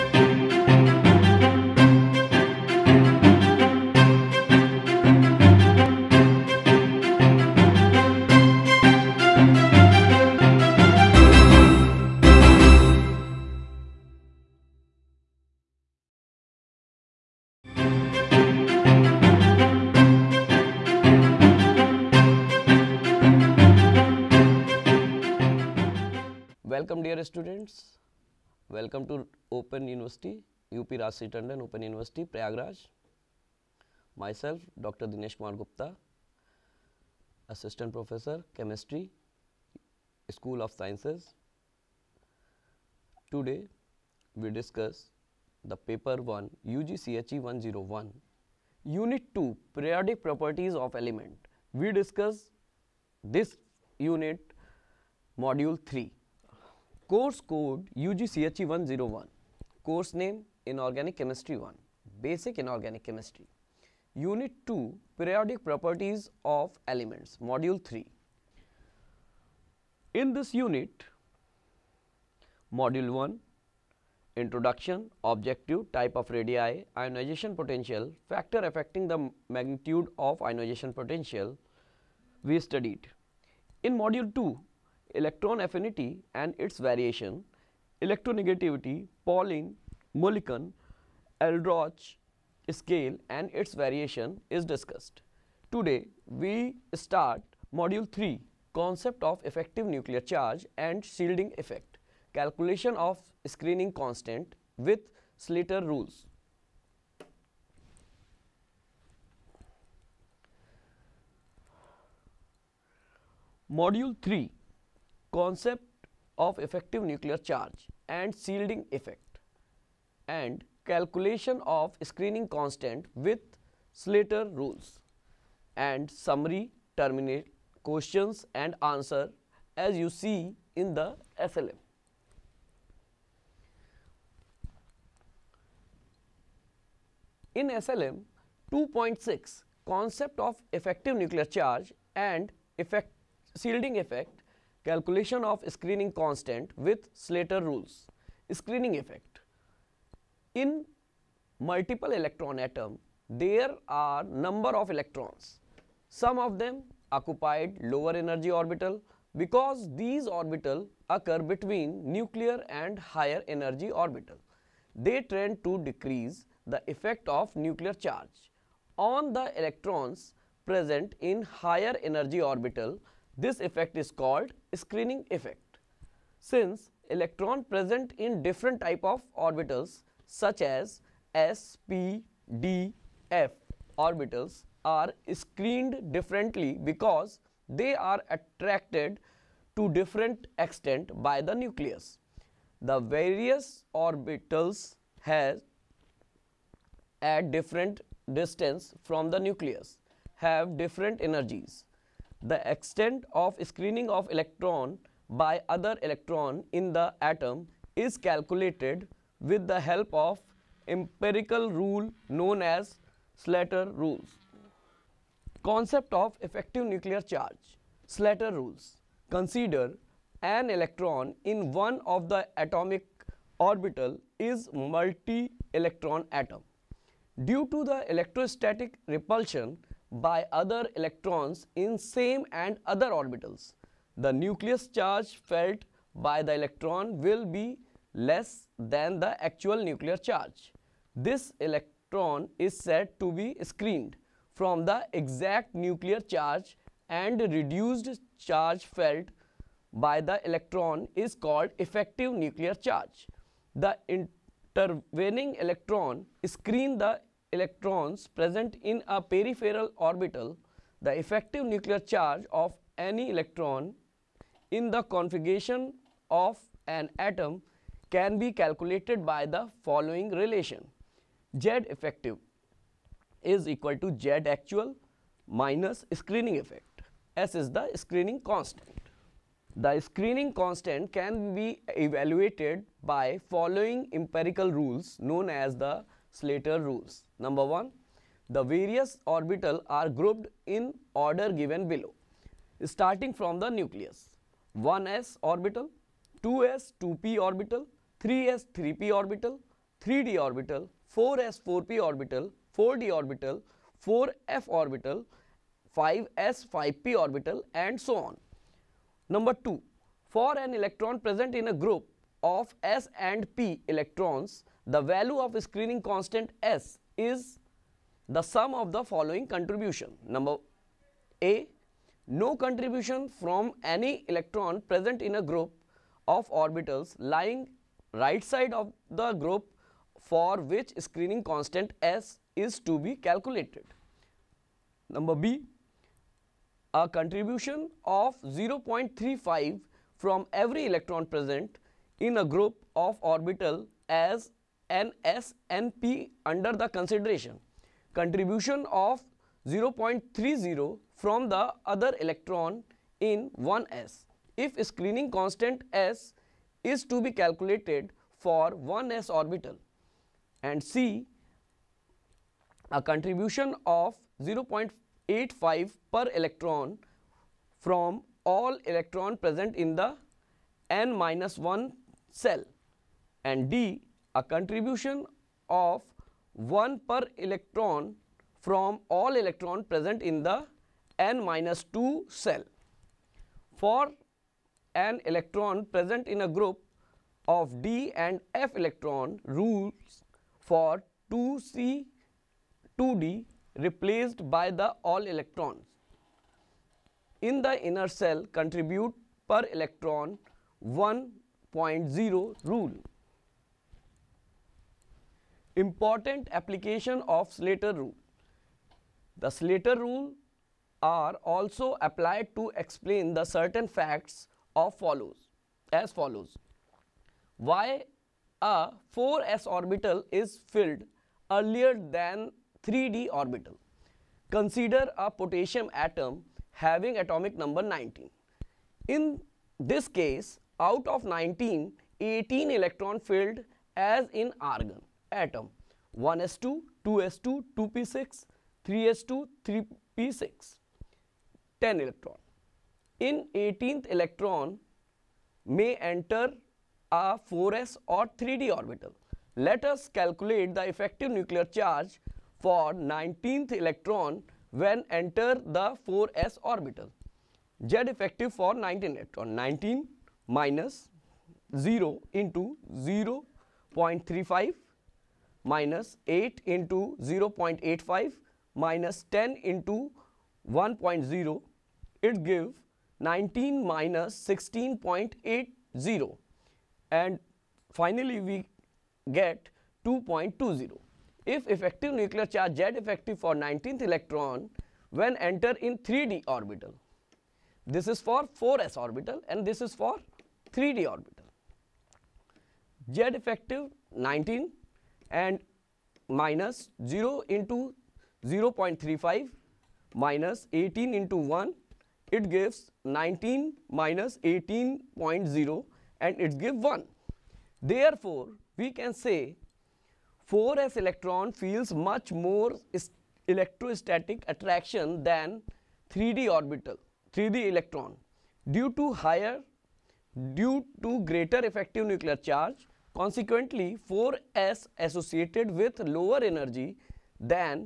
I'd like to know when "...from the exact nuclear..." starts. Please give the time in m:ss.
4:04.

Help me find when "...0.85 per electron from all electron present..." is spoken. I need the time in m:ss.
6:04.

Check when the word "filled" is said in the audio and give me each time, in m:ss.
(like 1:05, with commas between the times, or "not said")
7:00, 7:13.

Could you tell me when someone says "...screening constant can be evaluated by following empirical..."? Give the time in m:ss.
4:39.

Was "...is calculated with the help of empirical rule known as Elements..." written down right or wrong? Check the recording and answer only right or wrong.
wrong.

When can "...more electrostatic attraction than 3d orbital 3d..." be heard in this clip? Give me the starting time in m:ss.
8:32.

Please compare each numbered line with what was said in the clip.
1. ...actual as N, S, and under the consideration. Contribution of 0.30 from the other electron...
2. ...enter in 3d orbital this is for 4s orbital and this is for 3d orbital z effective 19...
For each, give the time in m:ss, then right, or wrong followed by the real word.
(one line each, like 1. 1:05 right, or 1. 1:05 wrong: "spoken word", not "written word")
1. 5:43 wrong: "orbital", not "actual"
2. 8:05 right.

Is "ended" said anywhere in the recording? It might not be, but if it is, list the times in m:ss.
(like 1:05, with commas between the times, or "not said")
not said.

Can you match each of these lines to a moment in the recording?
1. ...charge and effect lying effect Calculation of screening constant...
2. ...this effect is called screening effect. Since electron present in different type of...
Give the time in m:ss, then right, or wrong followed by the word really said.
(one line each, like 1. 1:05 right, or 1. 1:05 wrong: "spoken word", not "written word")
1. 2:21 wrong: "shielding", not "lying"
2. 2:53 right.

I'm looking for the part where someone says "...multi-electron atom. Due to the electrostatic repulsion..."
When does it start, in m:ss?
3:44.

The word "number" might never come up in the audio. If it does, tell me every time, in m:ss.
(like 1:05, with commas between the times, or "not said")
2:34, 4:47, 5:09, 5:20, 5:35, 7:07.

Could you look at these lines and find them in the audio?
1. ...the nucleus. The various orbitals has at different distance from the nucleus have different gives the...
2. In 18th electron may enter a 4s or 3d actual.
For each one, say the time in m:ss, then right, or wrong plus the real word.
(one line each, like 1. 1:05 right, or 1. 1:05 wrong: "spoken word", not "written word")
1. 3:11 wrong: "energies", not "gives"
2. 7:23 wrong: "orbital", not "actual".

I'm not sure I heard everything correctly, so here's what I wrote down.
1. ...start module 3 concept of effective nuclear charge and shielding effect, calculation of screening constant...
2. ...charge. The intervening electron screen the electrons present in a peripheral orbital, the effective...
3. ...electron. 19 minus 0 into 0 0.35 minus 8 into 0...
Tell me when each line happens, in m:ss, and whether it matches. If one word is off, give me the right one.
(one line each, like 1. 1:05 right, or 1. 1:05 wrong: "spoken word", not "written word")
1. 1:36 right
2. 4:12 right
3. 7:39 right.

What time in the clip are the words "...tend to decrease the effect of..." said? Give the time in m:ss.
2:45.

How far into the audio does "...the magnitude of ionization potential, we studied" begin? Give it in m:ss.
1:19.